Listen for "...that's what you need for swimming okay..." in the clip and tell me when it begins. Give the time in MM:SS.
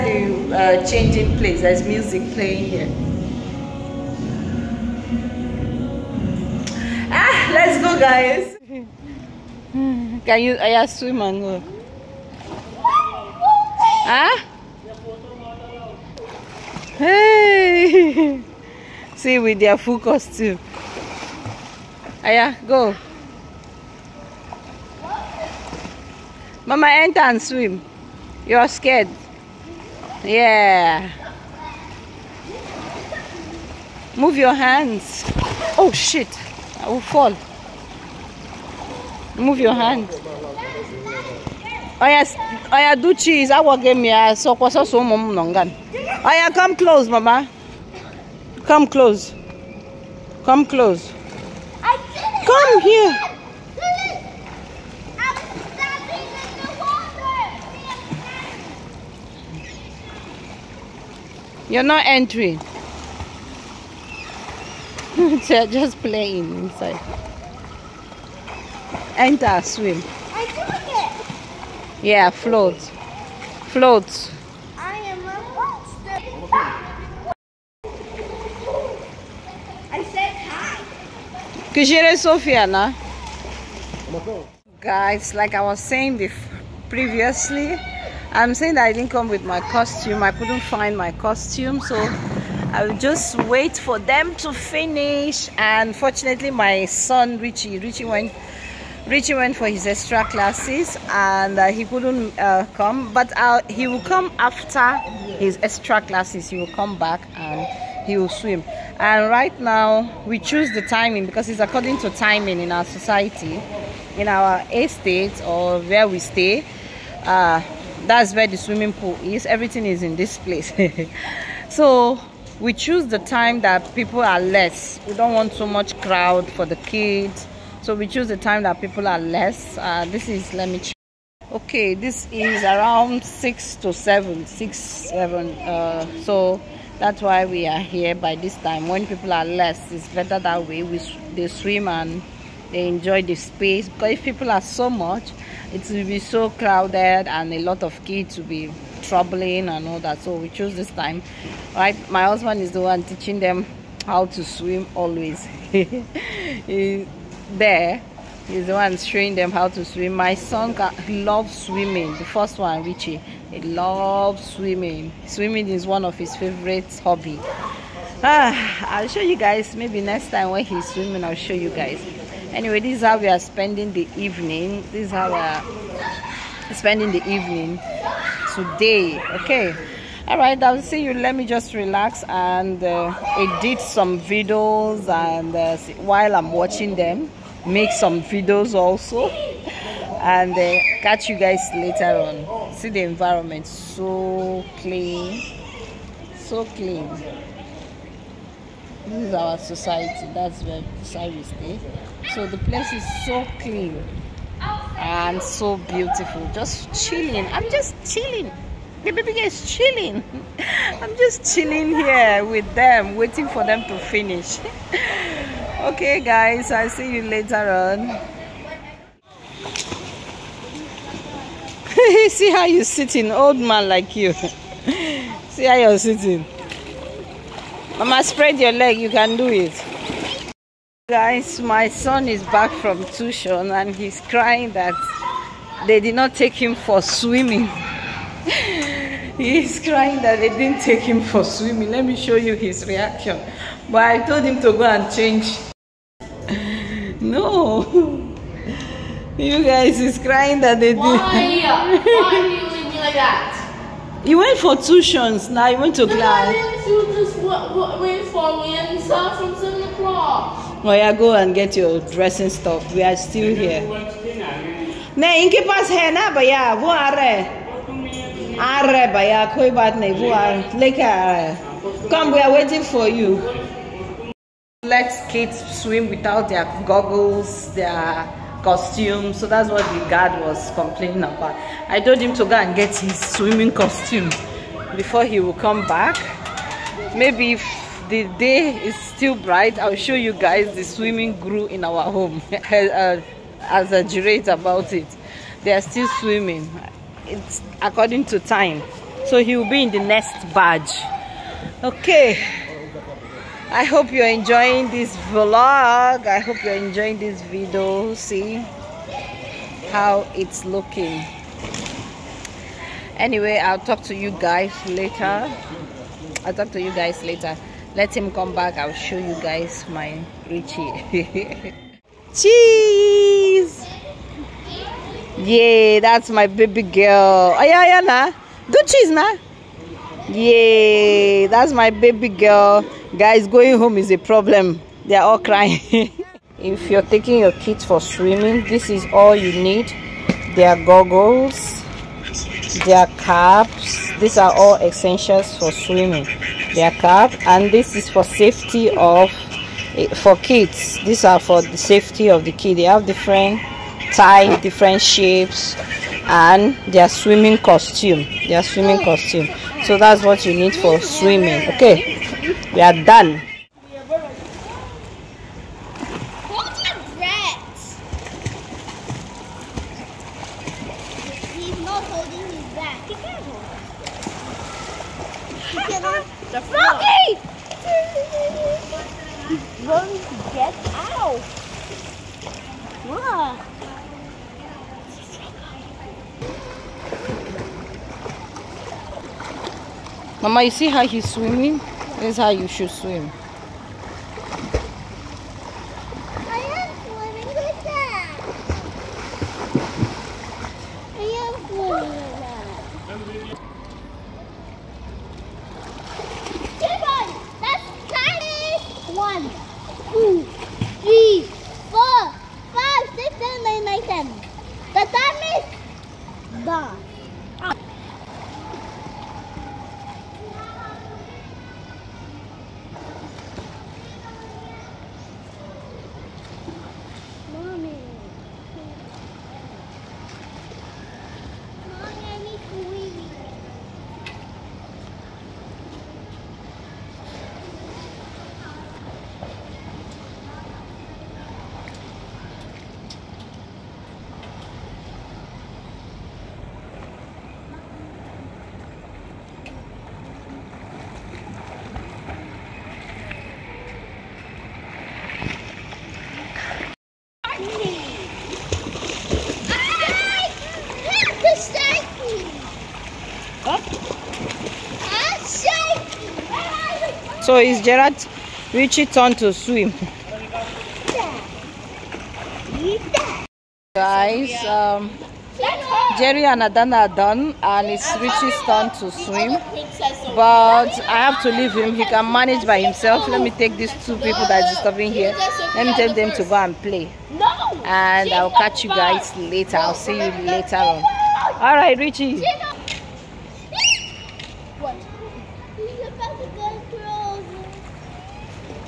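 05:59.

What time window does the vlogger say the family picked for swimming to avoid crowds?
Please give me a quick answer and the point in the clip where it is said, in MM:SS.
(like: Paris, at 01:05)
6 to 7, at 02:13.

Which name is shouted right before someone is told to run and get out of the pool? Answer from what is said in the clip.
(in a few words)
Smokey.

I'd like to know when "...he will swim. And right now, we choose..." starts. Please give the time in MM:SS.
01:48.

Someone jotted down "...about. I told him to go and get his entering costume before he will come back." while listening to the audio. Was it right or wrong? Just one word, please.
wrong.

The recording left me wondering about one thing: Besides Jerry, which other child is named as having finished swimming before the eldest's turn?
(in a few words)
Adana.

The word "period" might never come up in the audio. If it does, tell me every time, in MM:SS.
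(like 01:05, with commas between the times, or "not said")
not said.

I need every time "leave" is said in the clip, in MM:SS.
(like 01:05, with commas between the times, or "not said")
04:12, 08:01.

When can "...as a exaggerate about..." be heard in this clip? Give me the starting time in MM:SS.
04:52.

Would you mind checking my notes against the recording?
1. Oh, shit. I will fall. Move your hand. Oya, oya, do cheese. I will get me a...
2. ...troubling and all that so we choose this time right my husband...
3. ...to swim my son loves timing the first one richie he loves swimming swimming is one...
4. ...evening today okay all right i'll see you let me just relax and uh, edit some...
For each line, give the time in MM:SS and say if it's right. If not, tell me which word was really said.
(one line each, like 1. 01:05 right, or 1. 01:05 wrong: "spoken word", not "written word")
1. 00:35 right
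2. 02:29 right
3. 02:39 wrong: "swimming", not "timing"
4. 02:57 right.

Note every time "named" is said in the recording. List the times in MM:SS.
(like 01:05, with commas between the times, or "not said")
not said.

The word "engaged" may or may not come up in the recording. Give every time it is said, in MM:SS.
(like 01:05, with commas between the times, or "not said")
not said.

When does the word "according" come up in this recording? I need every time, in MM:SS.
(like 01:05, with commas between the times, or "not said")
01:51, 04:57.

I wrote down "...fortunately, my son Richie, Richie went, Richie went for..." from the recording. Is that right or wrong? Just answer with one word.
right.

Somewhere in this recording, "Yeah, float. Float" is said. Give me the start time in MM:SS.
01:12.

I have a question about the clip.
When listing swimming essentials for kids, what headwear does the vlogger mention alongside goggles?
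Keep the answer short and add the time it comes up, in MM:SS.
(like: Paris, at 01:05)
Caps, at 05:42.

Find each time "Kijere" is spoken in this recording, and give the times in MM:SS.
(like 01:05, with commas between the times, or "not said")
01:21.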